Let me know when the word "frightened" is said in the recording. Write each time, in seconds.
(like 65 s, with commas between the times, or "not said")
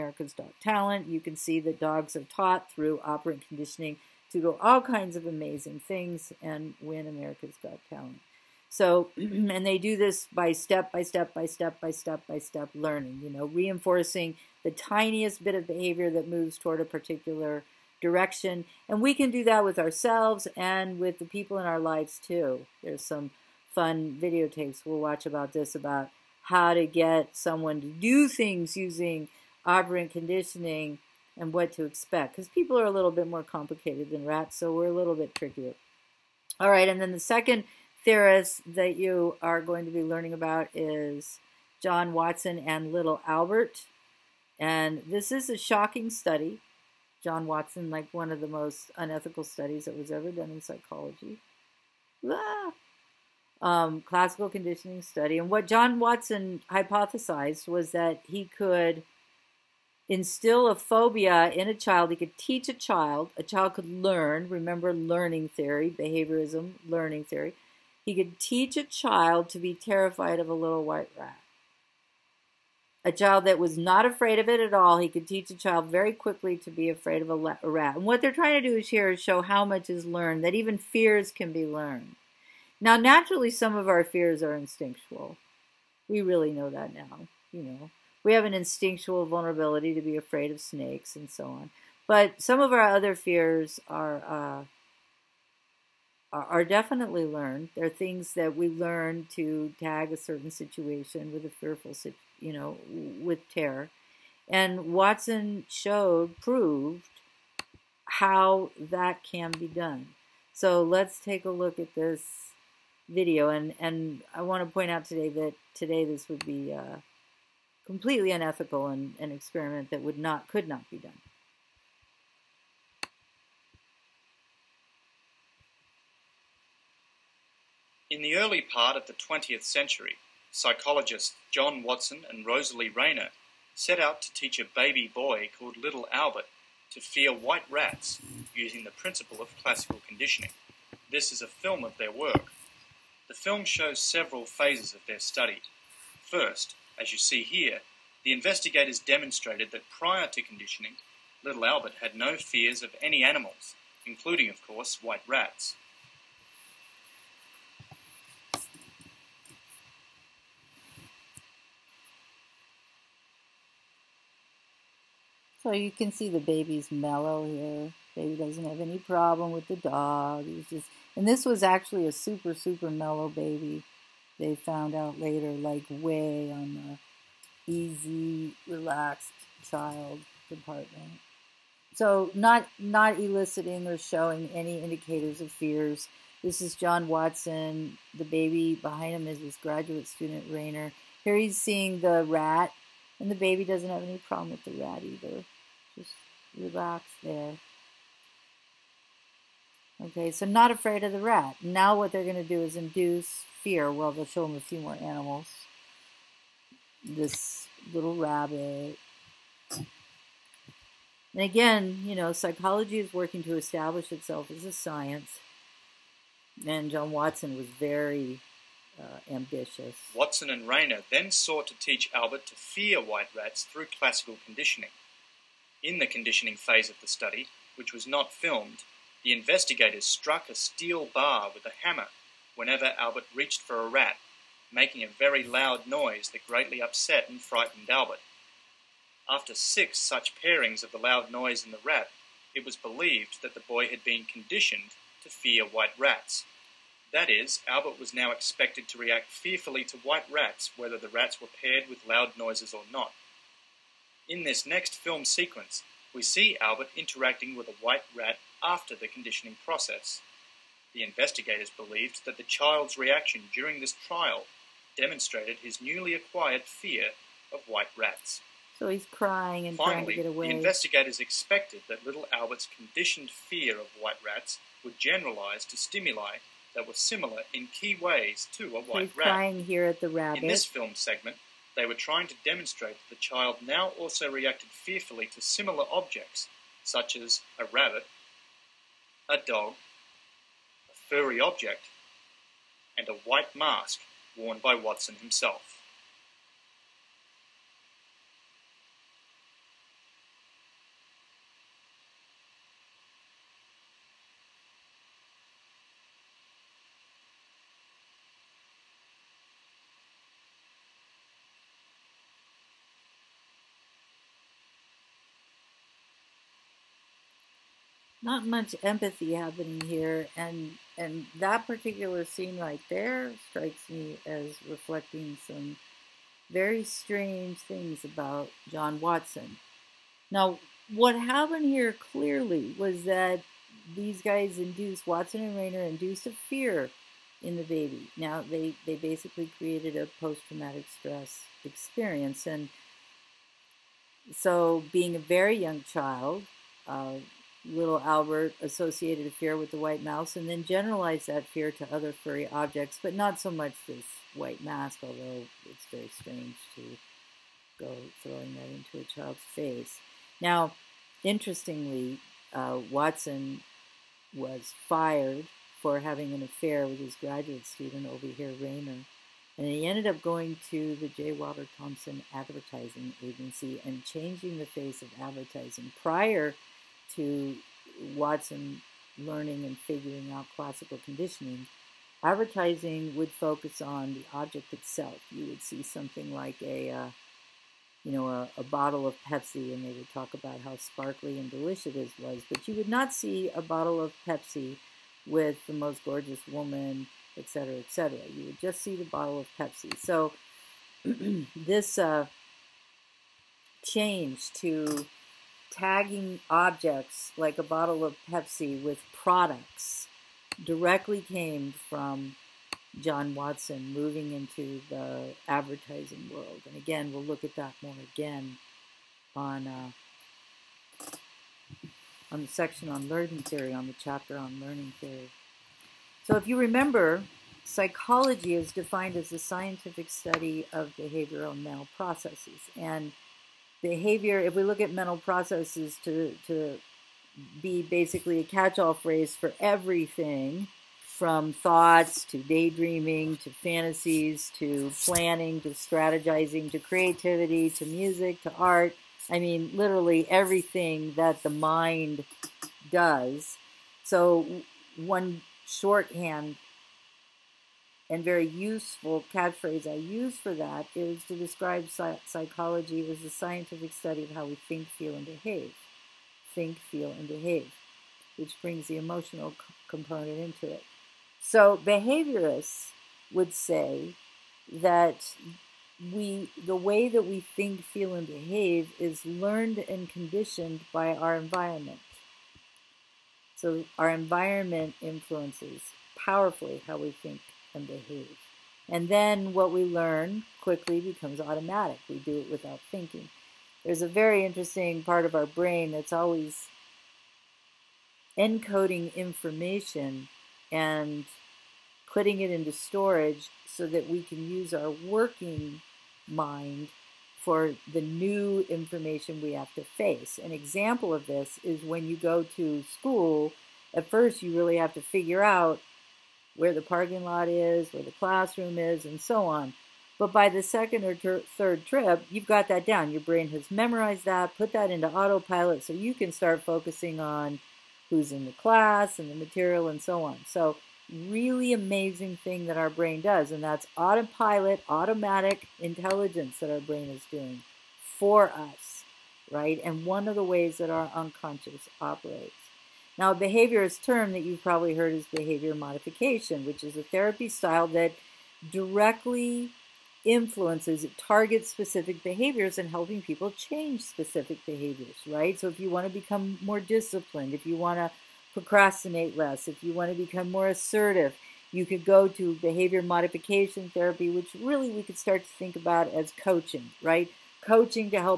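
237 s.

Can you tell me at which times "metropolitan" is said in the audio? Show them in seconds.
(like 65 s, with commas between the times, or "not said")
not said.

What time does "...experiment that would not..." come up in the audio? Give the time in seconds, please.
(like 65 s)
119 s.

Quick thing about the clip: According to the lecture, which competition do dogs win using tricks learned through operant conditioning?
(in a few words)
America's Dog Talent.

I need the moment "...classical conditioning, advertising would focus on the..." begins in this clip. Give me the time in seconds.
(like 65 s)
380 s.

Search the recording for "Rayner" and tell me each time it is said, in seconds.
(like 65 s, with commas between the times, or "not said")
132 s, 190 s, 220 s, 335 s, 368 s.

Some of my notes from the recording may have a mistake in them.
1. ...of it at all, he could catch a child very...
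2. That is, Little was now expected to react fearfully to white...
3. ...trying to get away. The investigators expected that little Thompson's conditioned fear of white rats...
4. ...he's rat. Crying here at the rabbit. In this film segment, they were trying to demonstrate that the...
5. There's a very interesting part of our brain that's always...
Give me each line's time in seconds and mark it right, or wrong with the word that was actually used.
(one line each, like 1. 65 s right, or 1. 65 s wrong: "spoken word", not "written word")
1. 74 s wrong: "teach", not "catch"
2. 247 s wrong: "Albert", not "Little"
3. 269 s wrong: "Albert", not "Thompson"
4. 279 s right
5. 493 s right.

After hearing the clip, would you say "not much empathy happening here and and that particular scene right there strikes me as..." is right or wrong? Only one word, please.
right.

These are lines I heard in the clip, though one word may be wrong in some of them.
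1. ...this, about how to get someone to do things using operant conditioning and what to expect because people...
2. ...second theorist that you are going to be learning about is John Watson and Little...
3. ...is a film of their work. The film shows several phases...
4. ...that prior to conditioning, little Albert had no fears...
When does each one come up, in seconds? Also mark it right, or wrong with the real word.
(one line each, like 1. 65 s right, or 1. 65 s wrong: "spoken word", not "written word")
1. 25 s right
2. 37 s right
3. 141 s right
4. 149 s right.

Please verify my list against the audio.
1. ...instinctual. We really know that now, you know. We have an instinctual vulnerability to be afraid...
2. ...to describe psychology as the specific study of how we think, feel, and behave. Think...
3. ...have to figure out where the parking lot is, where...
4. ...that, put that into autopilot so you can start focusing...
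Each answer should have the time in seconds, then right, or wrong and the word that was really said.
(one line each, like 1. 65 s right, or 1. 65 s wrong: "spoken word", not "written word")
1. 84 s right
2. 461 s wrong: "scientific", not "specific"
3. 514 s right
4. 524 s right.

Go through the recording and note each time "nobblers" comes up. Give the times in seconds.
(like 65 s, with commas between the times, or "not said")
not said.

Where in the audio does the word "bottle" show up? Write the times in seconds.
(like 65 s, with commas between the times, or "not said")
388 s, 393 s, 399 s, 407 s.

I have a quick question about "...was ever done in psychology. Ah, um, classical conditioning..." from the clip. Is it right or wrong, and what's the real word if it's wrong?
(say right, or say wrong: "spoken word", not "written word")
right.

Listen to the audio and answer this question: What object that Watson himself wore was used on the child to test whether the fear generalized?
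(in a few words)
a white mask.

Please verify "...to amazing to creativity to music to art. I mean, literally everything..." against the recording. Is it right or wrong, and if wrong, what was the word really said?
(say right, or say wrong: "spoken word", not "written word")
wrong: "strategizing", not "amazing".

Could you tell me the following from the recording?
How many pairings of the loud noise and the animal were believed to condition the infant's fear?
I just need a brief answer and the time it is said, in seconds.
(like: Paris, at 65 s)
6, at 239 s.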